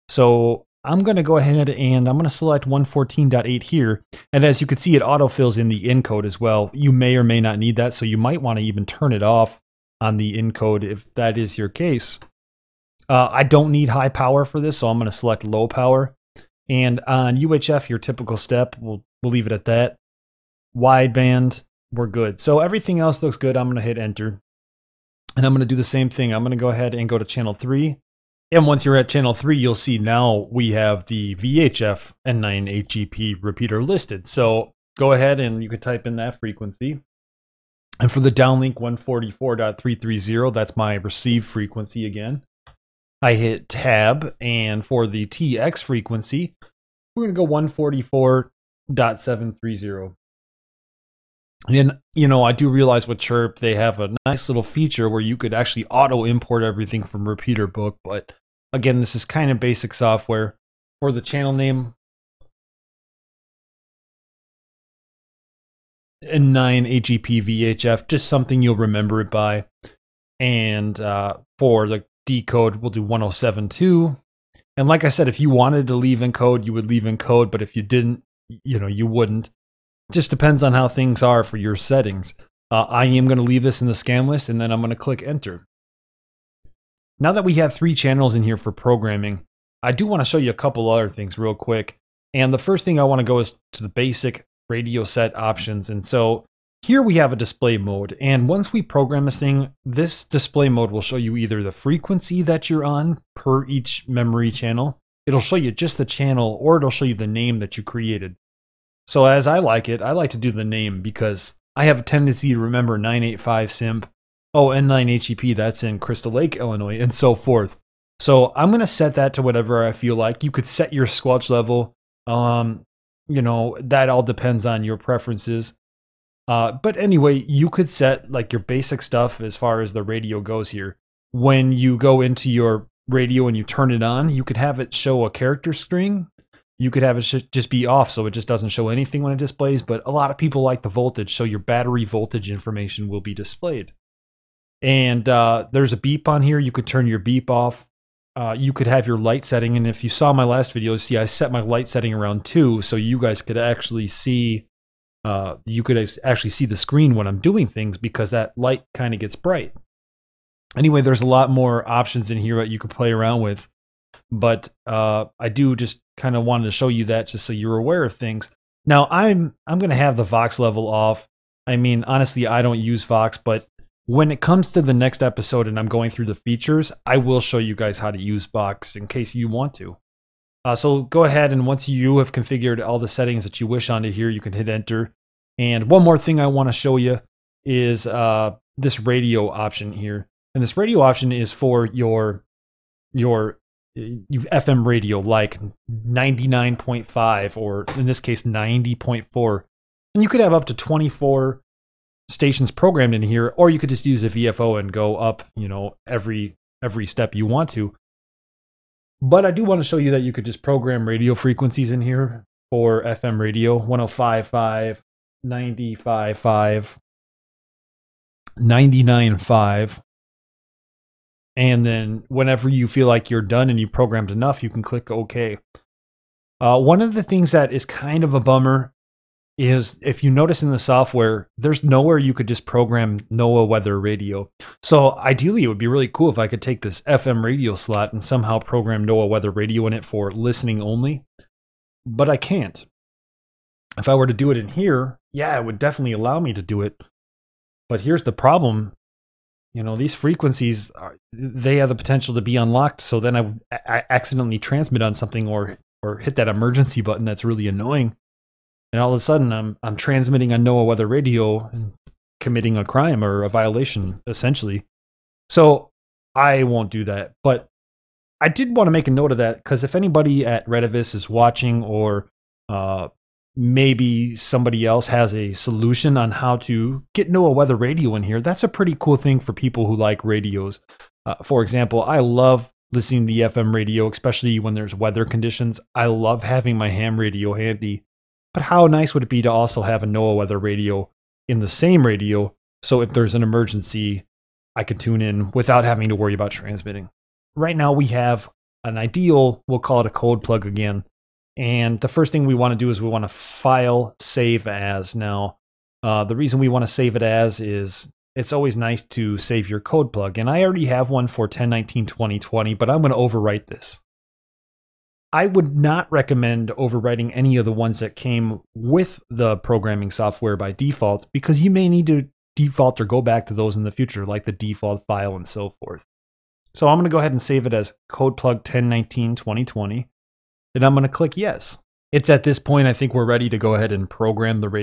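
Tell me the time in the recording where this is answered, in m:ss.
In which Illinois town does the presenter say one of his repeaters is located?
1:55.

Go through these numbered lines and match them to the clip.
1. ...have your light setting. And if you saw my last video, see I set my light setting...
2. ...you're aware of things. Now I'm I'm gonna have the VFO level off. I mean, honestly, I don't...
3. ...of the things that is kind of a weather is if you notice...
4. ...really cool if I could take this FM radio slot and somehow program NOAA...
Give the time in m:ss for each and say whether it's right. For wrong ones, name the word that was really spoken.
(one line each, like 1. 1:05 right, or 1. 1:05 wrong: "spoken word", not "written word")
1. 2:28 right
2. 2:47 wrong: "Vox", not "VFO"
3. 3:47 wrong: "bummer", not "weather"
4. 3:55 right.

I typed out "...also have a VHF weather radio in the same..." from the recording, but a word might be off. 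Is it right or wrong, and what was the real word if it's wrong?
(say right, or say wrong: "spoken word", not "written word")
wrong: "NOAA", not "VHF".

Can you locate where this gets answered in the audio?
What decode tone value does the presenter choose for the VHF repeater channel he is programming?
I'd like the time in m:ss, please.
1:13.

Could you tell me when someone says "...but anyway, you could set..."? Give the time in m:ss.
2:06.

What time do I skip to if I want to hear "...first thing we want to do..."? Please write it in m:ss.
5:02.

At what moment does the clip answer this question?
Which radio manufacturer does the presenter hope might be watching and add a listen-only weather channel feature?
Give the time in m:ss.
4:30.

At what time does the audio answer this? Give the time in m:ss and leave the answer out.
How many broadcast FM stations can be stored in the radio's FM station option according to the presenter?
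3:20.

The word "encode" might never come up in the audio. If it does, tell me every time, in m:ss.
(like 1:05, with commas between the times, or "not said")
0:05, 0:10.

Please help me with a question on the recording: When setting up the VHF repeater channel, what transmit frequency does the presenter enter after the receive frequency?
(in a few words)
144.730.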